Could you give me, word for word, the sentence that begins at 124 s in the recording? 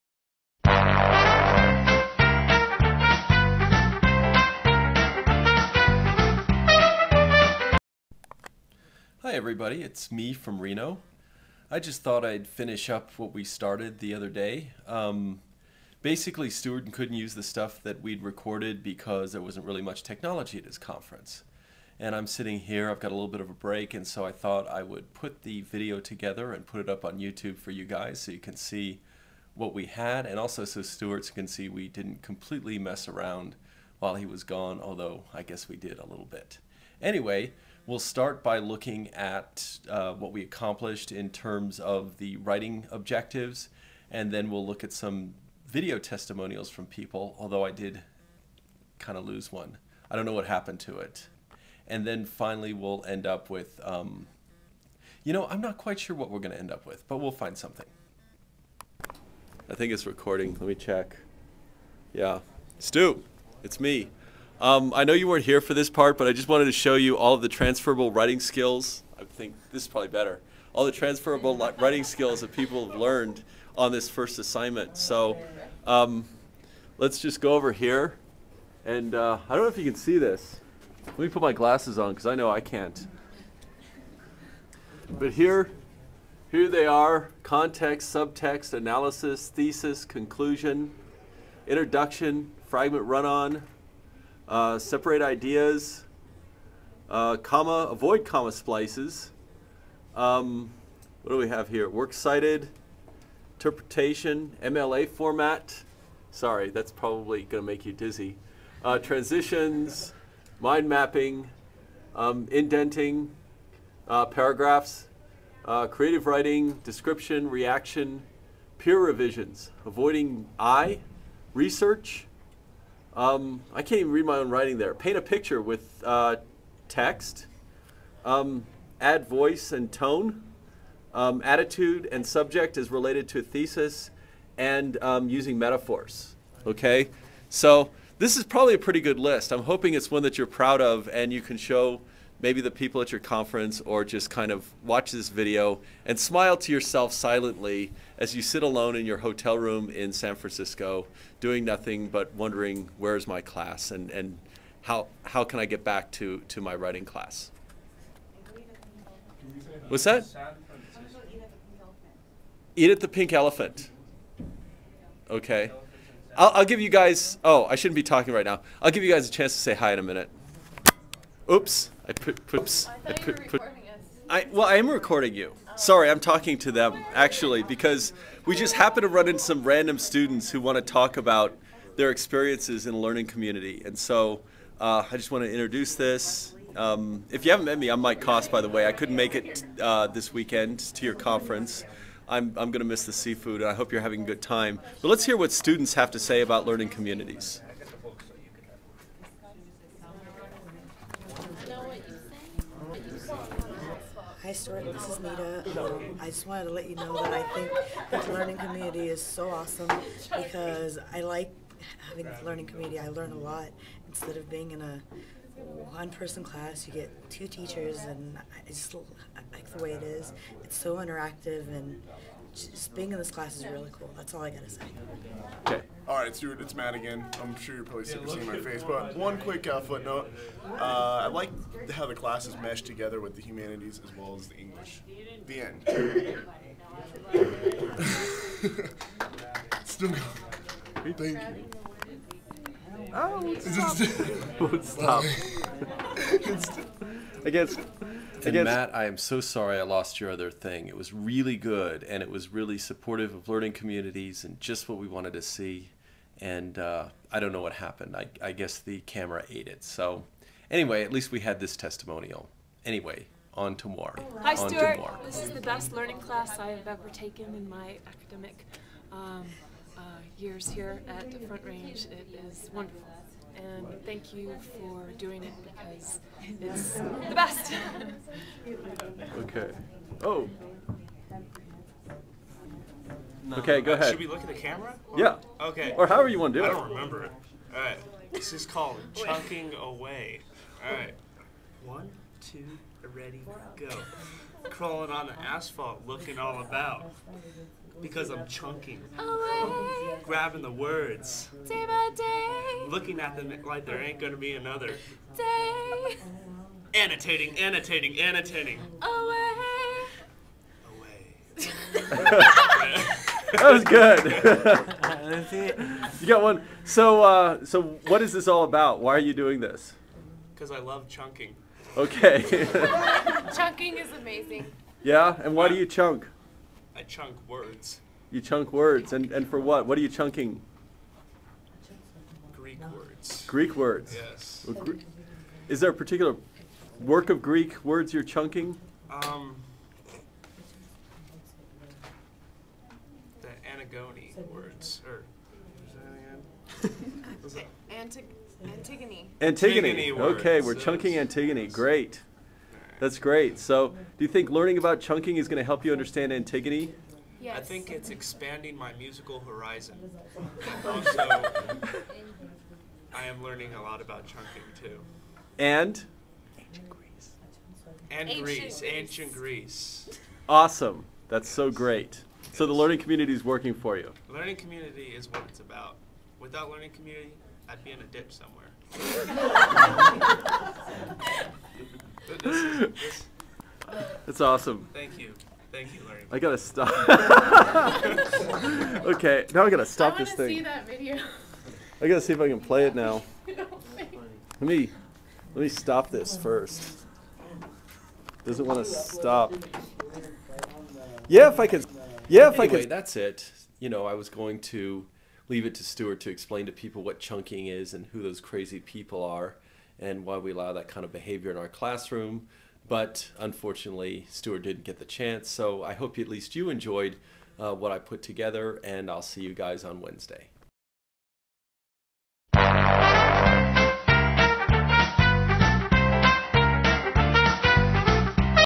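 Paint a picture with uh, text.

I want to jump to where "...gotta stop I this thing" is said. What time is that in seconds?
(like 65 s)
389 s.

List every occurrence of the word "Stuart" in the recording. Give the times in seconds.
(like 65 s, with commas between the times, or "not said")
16 s, 30 s, 204 s, 226 s, 264 s, 405 s, 414 s.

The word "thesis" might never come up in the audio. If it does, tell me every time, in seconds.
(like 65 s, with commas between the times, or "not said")
89 s, 133 s.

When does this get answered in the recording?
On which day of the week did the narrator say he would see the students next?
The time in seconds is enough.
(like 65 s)
419 s.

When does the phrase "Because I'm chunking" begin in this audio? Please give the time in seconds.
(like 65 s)
298 s.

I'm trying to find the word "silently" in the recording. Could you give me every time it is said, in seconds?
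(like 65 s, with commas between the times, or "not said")
147 s.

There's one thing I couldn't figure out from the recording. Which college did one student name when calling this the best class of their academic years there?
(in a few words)
Front Range.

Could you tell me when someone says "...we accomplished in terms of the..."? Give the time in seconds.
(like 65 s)
40 s.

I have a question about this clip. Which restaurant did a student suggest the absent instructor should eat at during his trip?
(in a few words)
the Pink Elephant.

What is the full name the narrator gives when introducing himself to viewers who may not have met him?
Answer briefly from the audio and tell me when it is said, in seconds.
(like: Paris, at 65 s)
Mike Coste, at 187 s.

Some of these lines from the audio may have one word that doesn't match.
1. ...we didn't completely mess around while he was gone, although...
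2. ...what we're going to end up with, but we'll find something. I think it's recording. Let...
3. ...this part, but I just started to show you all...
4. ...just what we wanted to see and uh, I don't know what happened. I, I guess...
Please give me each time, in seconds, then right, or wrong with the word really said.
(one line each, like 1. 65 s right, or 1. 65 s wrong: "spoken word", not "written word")
1. 31 s right
2. 56 s right
3. 65 s wrong: "wanted", not "started"
4. 254 s right.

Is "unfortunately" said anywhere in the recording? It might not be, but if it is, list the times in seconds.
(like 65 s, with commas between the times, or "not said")
413 s.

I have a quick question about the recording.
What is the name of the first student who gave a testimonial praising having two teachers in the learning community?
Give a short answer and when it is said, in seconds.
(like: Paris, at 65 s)
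Nita, at 205 s.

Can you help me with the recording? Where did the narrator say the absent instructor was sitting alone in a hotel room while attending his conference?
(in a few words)
San Francisco.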